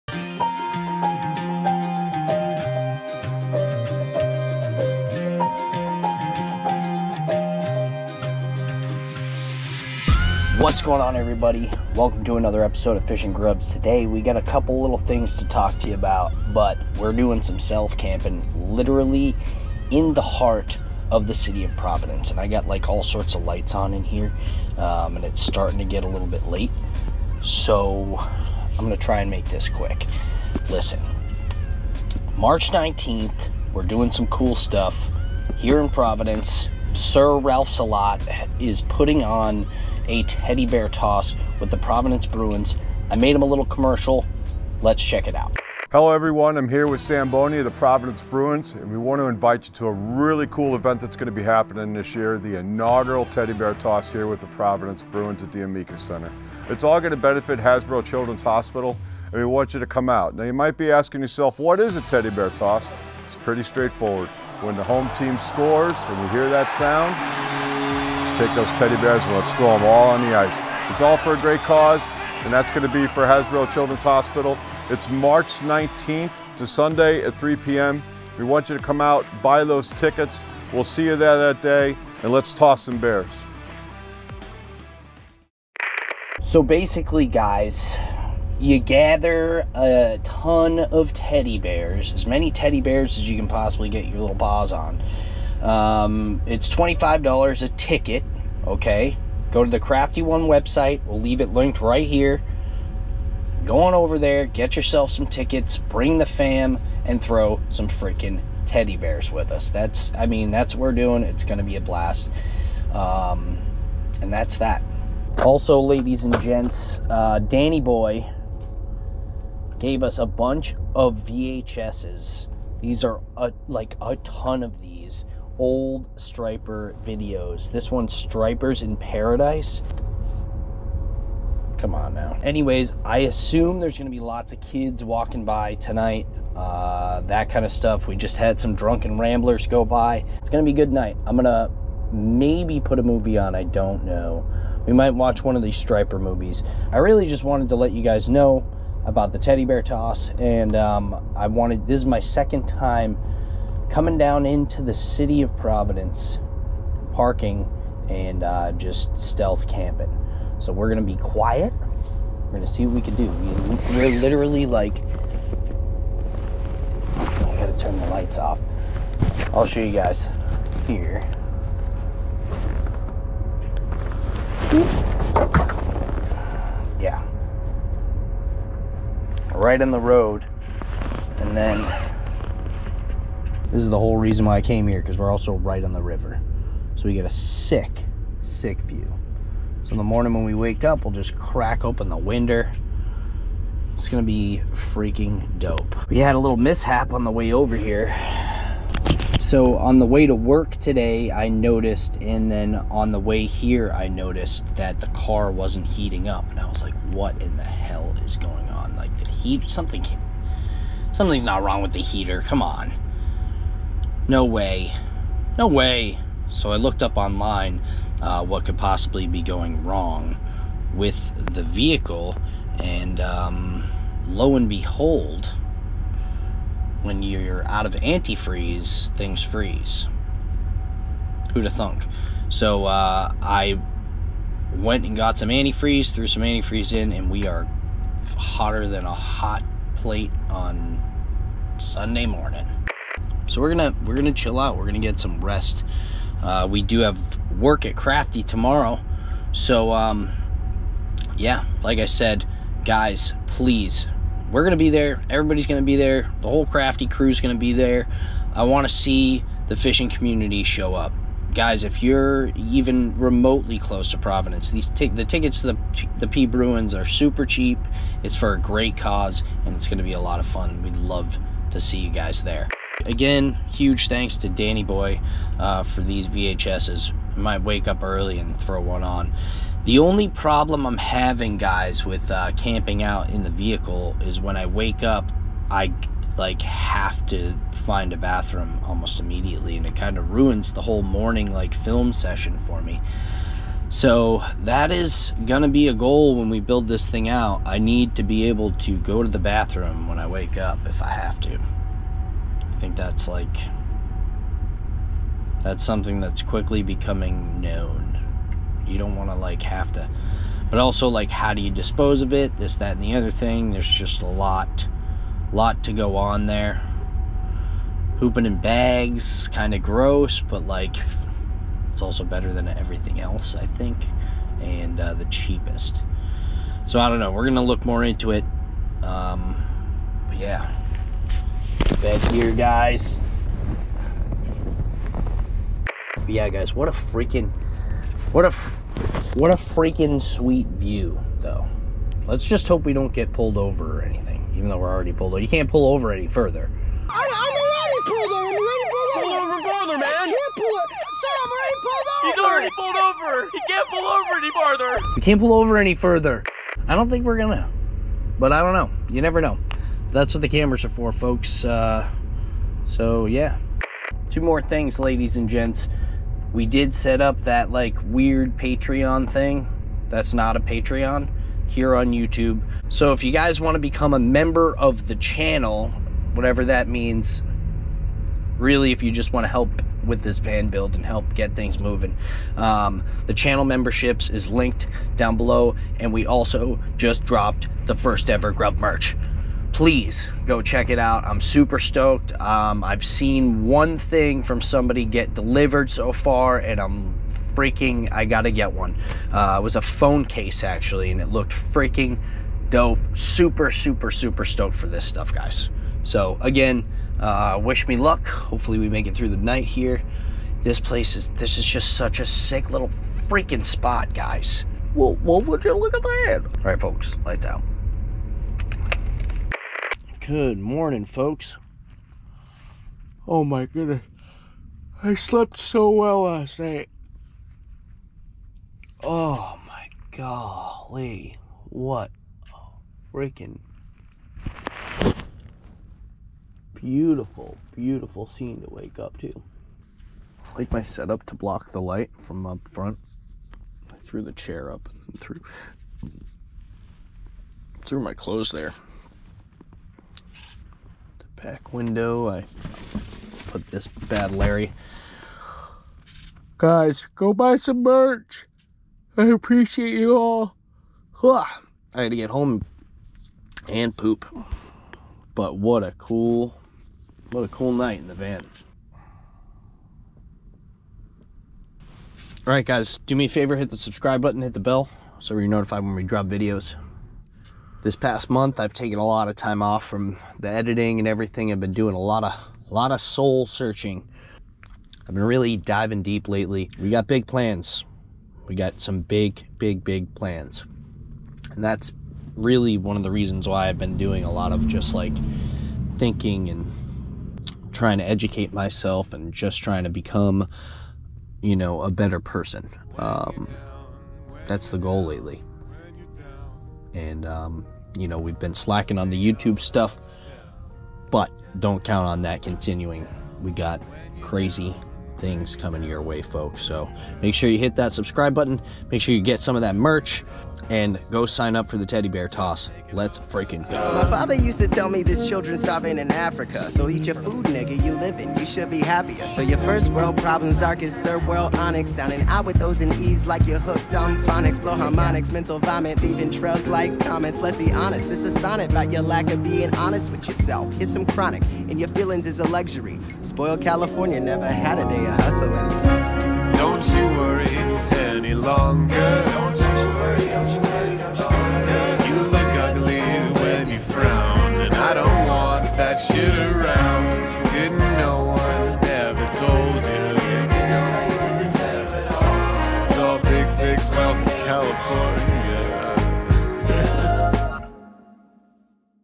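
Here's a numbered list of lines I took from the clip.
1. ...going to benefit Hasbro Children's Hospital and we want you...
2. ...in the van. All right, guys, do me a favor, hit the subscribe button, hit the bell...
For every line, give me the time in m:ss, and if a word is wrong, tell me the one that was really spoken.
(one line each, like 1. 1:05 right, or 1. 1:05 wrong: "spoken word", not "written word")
1. 0:57 right
2. 7:47 right.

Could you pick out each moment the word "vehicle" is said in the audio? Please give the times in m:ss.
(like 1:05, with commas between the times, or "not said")
3:41, 4:43.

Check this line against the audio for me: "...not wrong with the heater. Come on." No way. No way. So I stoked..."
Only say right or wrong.
wrong.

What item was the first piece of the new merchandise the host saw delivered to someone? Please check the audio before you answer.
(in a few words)
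Phone case.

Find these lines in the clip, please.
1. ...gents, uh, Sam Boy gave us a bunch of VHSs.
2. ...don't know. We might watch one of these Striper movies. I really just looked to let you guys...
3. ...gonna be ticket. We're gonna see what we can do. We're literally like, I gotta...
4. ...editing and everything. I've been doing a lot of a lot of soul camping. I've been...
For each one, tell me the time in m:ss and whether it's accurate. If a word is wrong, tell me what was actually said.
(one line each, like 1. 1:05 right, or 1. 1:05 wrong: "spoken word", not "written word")
1. 1:56 wrong: "Danny", not "Sam"
2. 2:23 wrong: "wanted", not "looked"
3. 2:40 wrong: "quiet", not "ticket"
4. 8:00 wrong: "searching", not "camping".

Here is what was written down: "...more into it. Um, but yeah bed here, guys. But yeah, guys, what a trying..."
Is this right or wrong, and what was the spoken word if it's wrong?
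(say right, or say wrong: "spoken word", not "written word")
wrong: "freaking", not "trying".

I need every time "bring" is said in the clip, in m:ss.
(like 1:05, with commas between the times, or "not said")
1:45.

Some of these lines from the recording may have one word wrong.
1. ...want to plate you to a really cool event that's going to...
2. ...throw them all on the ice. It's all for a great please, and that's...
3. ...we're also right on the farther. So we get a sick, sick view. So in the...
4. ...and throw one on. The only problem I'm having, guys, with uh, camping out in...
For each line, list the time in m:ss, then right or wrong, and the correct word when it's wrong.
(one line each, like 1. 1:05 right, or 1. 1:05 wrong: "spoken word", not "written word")
1. 0:48 wrong: "invite", not "plate"
2. 1:09 wrong: "cause", not "please"
3. 3:05 wrong: "river", not "farther"
4. 4:38 right.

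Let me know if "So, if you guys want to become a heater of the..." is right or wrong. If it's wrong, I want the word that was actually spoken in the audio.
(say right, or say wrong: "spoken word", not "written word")
wrong: "member", not "heater".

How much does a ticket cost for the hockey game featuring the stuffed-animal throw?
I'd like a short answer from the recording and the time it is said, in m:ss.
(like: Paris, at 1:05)
$25, at 1:36.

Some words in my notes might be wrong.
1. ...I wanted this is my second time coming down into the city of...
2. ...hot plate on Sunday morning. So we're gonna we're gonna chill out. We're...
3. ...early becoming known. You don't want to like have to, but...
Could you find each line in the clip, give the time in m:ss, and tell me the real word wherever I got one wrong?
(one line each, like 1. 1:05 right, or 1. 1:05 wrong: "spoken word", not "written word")
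1. 2:31 right
2. 3:59 right
3. 5:06 wrong: "quickly", not "early".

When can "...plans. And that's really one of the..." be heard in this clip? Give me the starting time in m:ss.
8:10.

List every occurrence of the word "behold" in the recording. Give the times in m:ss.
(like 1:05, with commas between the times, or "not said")
3:44.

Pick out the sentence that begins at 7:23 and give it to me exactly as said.
I threw the chair up and threw, threw my clothes there back window.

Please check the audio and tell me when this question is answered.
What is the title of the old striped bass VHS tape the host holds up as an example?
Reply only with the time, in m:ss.
2:08.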